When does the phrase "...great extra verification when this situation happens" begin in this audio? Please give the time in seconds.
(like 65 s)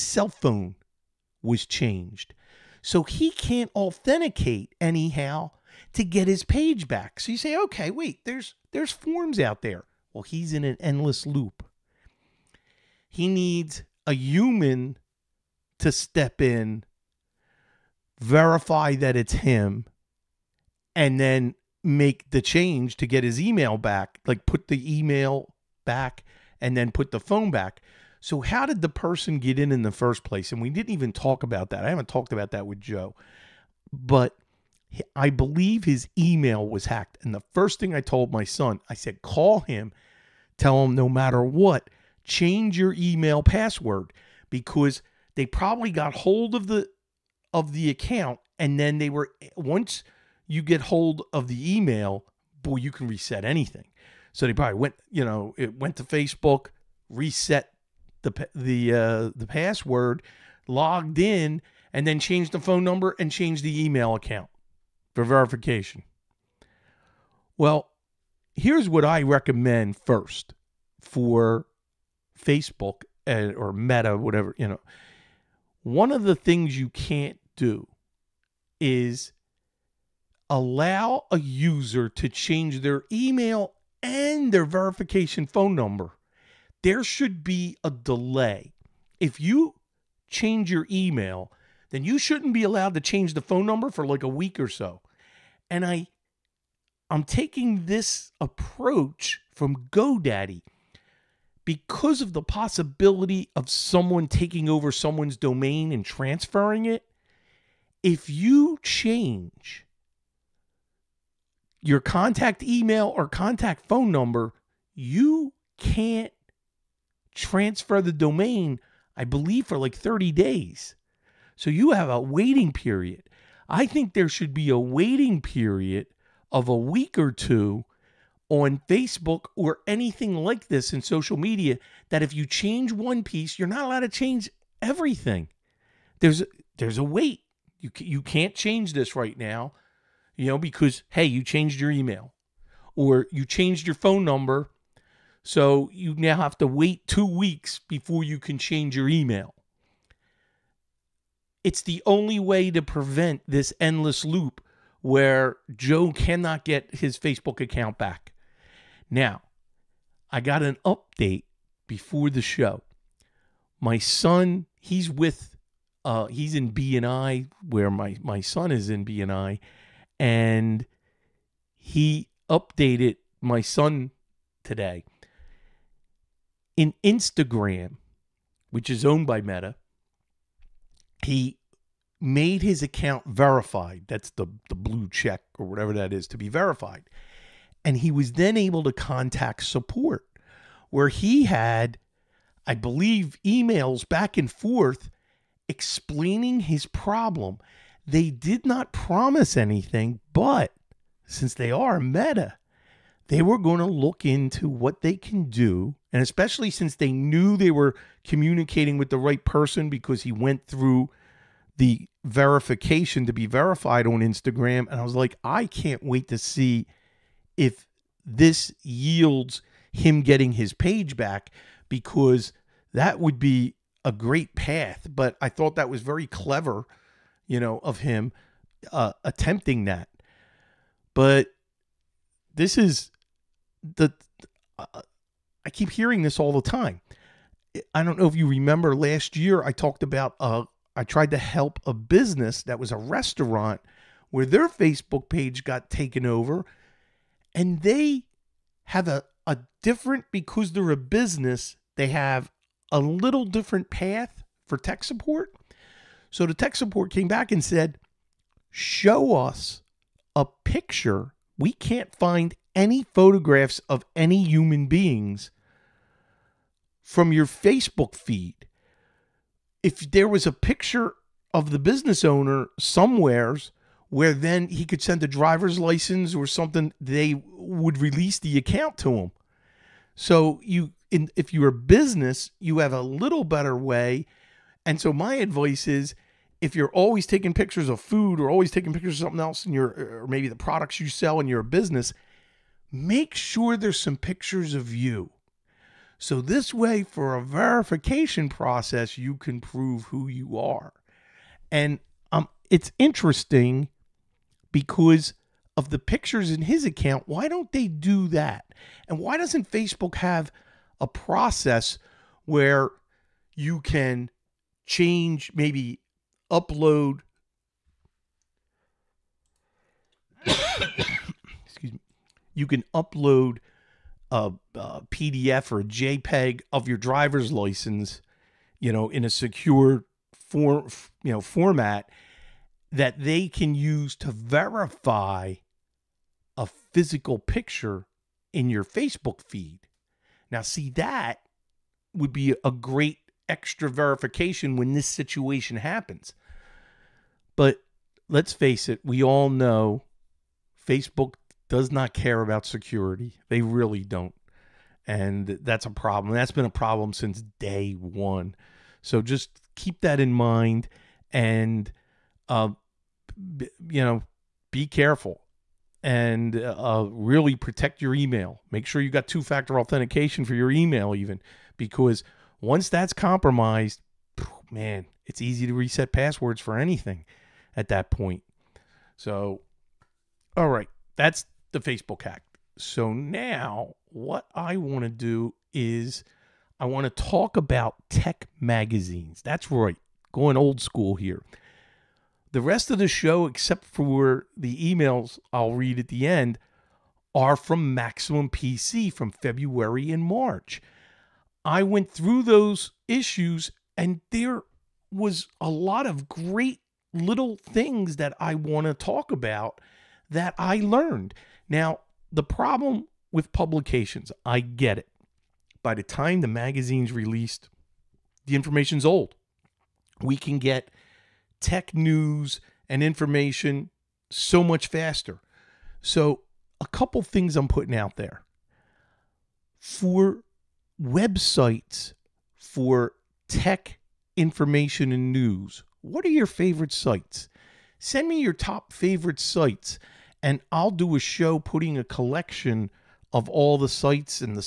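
342 s.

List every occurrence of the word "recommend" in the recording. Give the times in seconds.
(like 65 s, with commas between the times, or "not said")
69 s.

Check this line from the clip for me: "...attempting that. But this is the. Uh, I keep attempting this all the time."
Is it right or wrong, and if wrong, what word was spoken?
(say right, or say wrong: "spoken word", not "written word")
wrong: "hearing", not "attempting".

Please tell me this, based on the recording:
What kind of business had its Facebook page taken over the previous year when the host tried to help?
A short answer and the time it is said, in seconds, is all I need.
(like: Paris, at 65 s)
A restaurant, at 242 s.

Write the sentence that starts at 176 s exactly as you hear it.
In Instagram, which is owned by Meta, he made his account verified.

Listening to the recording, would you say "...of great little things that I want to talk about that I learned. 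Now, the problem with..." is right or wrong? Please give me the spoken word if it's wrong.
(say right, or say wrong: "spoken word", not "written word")
right.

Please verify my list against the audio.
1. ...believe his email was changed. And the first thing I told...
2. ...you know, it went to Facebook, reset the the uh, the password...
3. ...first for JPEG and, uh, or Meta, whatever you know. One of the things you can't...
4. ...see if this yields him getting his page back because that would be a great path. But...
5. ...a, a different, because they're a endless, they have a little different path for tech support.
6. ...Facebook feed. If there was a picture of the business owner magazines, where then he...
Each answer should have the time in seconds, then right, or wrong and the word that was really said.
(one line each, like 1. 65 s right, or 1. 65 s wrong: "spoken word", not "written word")
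1. 35 s wrong: "hacked", not "changed"
2. 55 s right
3. 69 s wrong: "Facebook", not "JPEG"
4. 216 s right
5. 249 s wrong: "business", not "endless"
6. 267 s wrong: "somewheres", not "magazines".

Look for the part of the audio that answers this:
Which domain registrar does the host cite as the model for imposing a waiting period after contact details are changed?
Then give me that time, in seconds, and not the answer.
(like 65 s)
99 s.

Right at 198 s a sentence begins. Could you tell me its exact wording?
They did not promise anything, but since they are meta, they were going to look into what they can do.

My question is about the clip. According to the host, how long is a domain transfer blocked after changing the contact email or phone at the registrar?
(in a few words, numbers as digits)
30 days.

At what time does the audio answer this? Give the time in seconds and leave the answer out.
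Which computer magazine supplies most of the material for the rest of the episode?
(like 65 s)
397 s.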